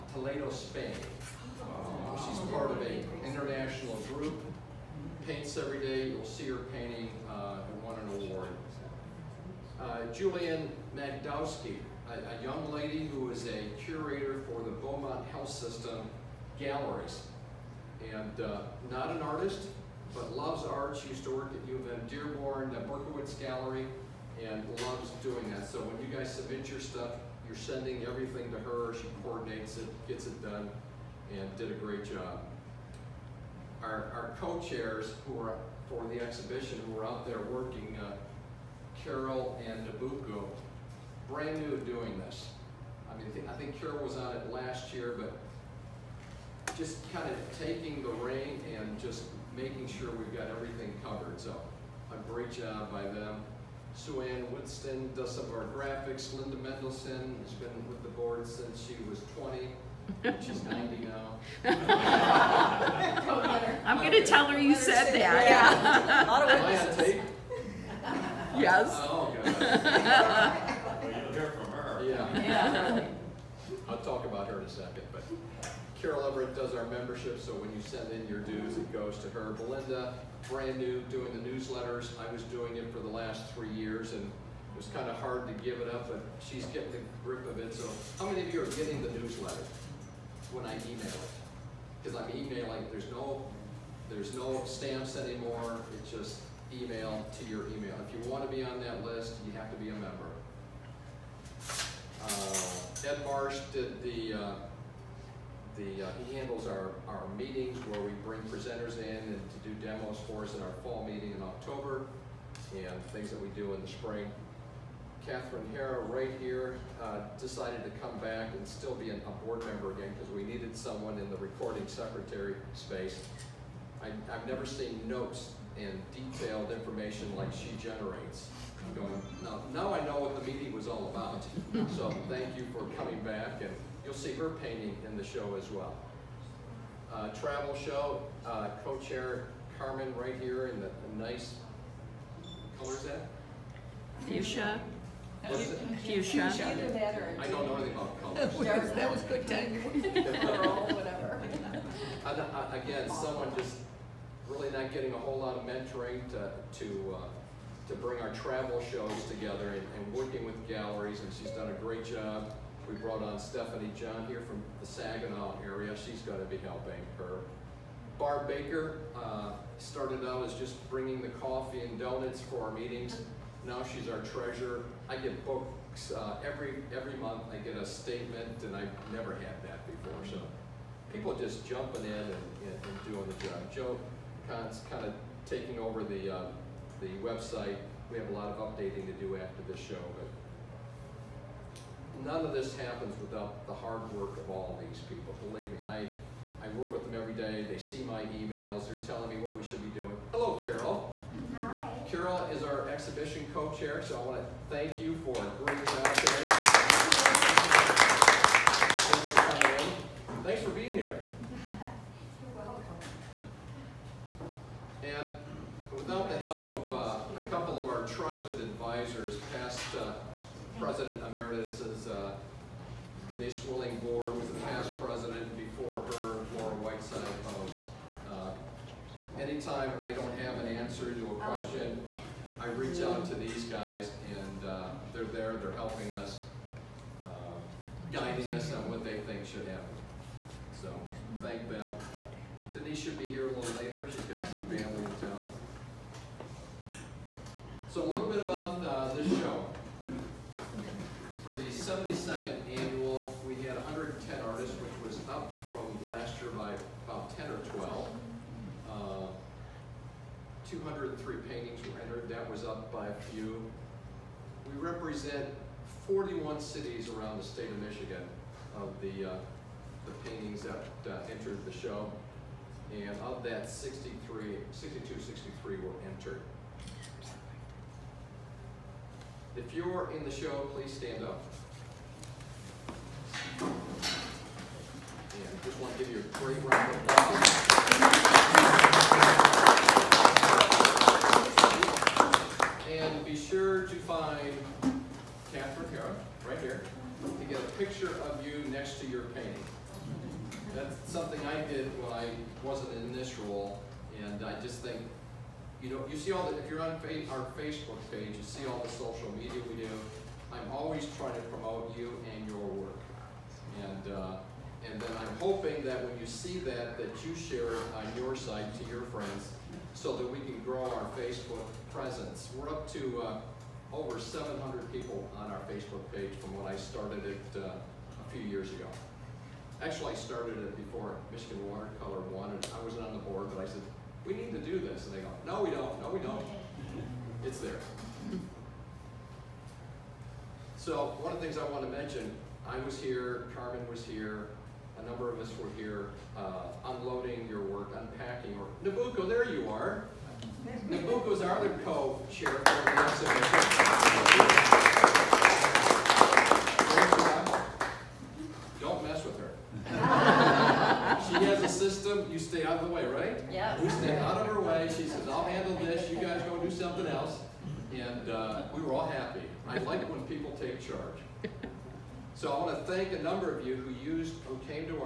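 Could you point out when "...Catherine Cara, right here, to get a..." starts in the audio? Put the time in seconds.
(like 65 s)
295 s.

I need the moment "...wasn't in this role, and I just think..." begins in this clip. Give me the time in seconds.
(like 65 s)
302 s.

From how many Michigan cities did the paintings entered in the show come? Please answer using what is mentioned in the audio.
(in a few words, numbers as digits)
41.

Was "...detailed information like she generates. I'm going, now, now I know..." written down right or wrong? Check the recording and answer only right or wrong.
right.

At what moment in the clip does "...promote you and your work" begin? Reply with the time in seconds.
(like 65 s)
311 s.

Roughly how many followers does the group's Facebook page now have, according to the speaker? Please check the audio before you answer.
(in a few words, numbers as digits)
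over 700.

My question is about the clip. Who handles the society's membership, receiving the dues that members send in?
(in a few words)
Carol Everett.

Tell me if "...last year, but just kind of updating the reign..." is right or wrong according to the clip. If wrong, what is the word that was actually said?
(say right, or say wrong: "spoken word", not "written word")
wrong: "taking", not "updating".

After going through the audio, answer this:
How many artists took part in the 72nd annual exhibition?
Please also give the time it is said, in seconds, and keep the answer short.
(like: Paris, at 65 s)
110, at 253 s.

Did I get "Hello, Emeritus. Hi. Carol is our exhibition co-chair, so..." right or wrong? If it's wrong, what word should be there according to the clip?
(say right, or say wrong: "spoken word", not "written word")
wrong: "Carol", not "Emeritus".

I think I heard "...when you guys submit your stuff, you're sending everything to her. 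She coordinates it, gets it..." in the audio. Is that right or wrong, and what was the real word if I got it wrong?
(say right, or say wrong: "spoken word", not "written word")
right.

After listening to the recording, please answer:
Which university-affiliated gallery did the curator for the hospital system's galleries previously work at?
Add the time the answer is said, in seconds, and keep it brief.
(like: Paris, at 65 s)
Berkowitz Gallery, at 22 s.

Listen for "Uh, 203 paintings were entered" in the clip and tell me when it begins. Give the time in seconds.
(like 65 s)
258 s.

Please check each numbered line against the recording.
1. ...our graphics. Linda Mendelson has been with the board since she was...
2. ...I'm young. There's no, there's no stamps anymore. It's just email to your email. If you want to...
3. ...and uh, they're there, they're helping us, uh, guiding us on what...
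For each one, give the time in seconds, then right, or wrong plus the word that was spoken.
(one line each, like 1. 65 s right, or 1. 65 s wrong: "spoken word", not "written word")
1. 55 s right
2. 92 s wrong: "emailing", not "young"
3. 234 s right.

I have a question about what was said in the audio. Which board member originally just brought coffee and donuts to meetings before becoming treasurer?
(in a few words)
Barb Baker.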